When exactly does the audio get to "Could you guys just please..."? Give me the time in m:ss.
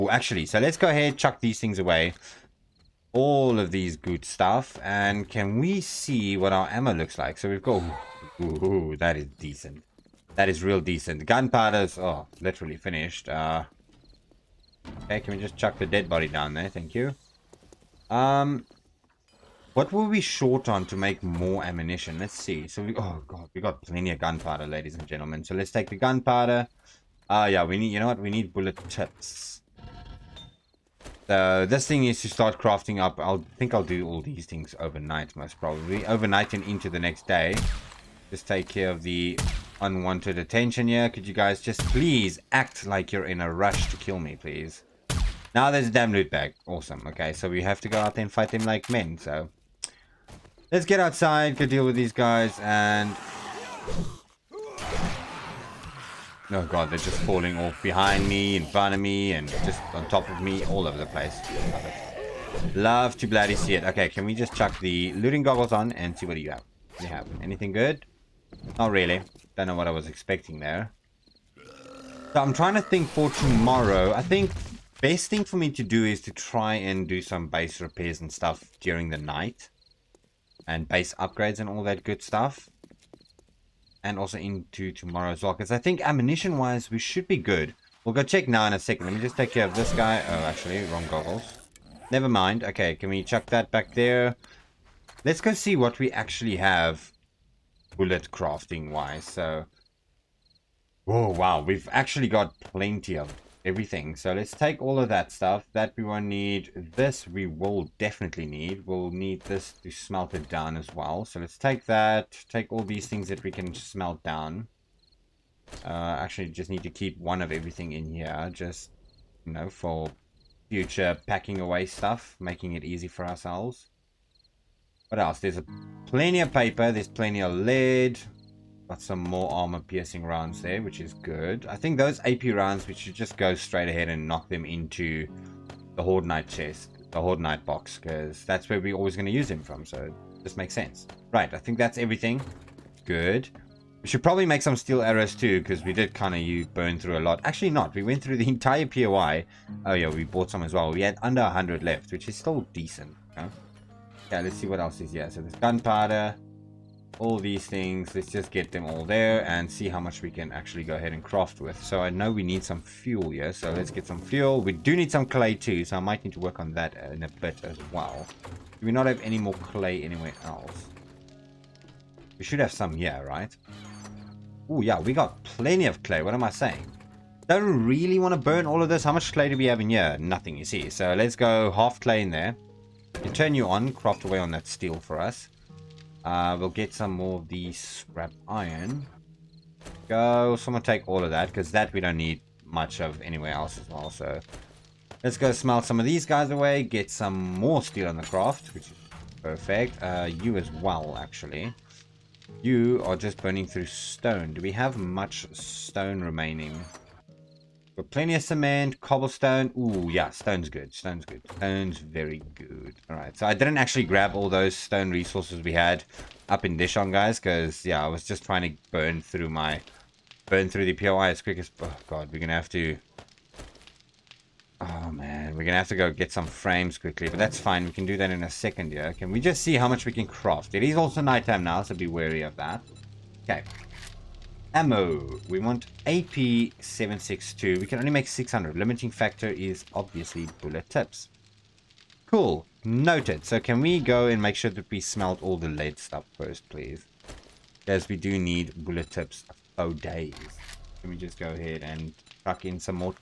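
0:41.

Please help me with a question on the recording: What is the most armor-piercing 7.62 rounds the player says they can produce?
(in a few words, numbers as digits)
600.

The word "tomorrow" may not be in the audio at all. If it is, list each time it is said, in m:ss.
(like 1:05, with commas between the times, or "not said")
1:13, 1:24.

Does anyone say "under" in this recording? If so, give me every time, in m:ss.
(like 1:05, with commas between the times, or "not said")
2:31.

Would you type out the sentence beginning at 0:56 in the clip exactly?
Oh god, they're just falling off behind me, in front of me, and just on top of me, all over the place.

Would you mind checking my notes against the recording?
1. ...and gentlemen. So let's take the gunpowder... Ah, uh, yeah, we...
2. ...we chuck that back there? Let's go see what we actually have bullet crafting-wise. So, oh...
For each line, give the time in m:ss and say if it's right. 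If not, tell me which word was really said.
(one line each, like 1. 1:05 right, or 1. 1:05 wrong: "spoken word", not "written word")
1. 0:24 right
2. 1:33 right.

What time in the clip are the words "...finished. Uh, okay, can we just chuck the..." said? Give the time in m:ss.
0:12.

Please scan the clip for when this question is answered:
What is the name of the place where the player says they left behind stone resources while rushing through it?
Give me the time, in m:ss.
3:36.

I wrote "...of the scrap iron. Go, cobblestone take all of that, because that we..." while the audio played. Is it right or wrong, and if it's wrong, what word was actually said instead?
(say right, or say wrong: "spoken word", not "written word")
wrong: "someone", not "cobblestone".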